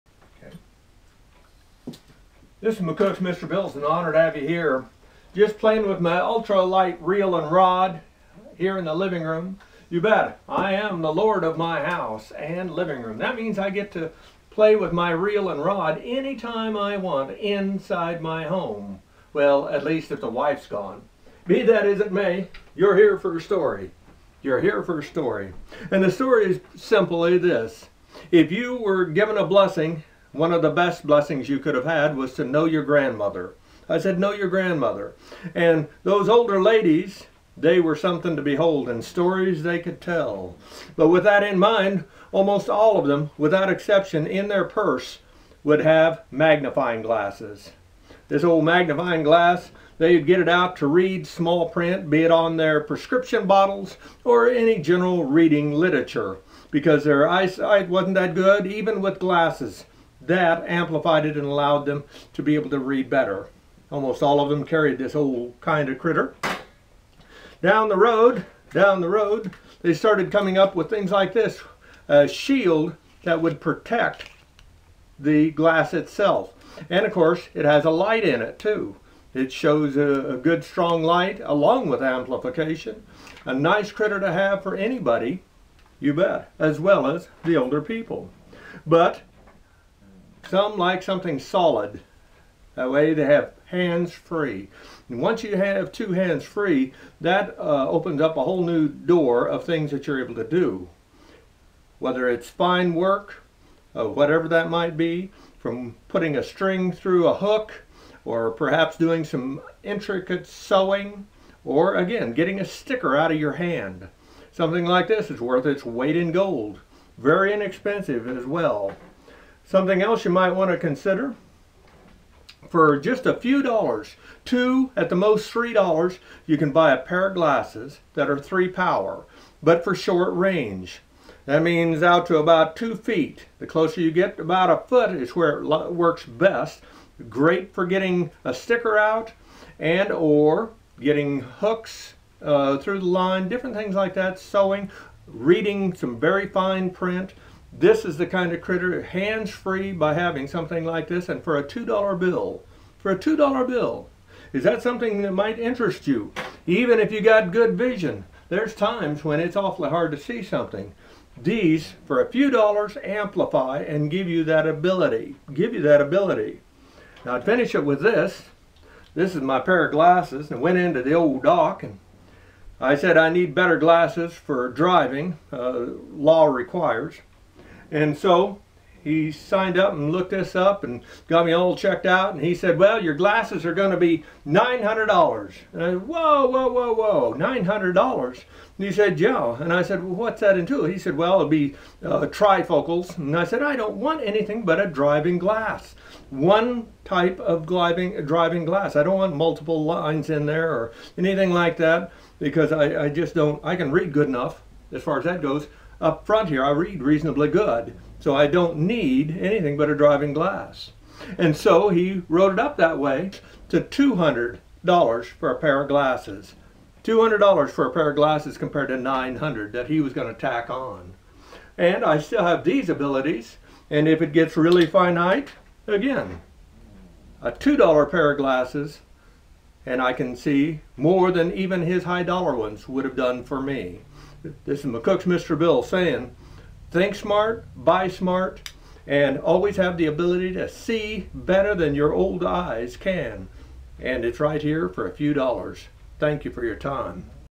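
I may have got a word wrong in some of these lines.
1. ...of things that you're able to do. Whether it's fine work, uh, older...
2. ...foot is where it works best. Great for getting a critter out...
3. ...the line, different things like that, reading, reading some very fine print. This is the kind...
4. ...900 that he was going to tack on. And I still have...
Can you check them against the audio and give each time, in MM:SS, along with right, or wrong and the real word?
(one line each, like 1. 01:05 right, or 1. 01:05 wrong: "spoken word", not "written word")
1. 01:39 wrong: "whatever", not "older"
2. 02:14 wrong: "sticker", not "critter"
3. 02:22 wrong: "sewing", not "reading"
4. 03:38 right.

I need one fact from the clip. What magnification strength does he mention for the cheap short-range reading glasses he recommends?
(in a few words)
3 power.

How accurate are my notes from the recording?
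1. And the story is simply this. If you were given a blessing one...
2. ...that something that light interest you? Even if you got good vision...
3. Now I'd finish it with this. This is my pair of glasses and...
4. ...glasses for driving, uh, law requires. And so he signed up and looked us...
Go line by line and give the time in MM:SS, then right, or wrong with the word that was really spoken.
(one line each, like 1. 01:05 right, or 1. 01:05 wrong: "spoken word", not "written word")
1. 00:25 right
2. 02:34 wrong: "might", not "light"
3. 02:47 right
4. 02:53 right.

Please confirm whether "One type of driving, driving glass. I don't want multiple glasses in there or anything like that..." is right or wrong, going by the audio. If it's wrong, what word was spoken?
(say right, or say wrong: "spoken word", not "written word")
wrong: "lines", not "glasses".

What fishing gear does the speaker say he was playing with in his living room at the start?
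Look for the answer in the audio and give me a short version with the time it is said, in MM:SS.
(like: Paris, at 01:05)
ultralight reel and rod, at 00:06.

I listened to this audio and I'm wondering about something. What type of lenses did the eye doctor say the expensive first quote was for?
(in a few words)
trifocals.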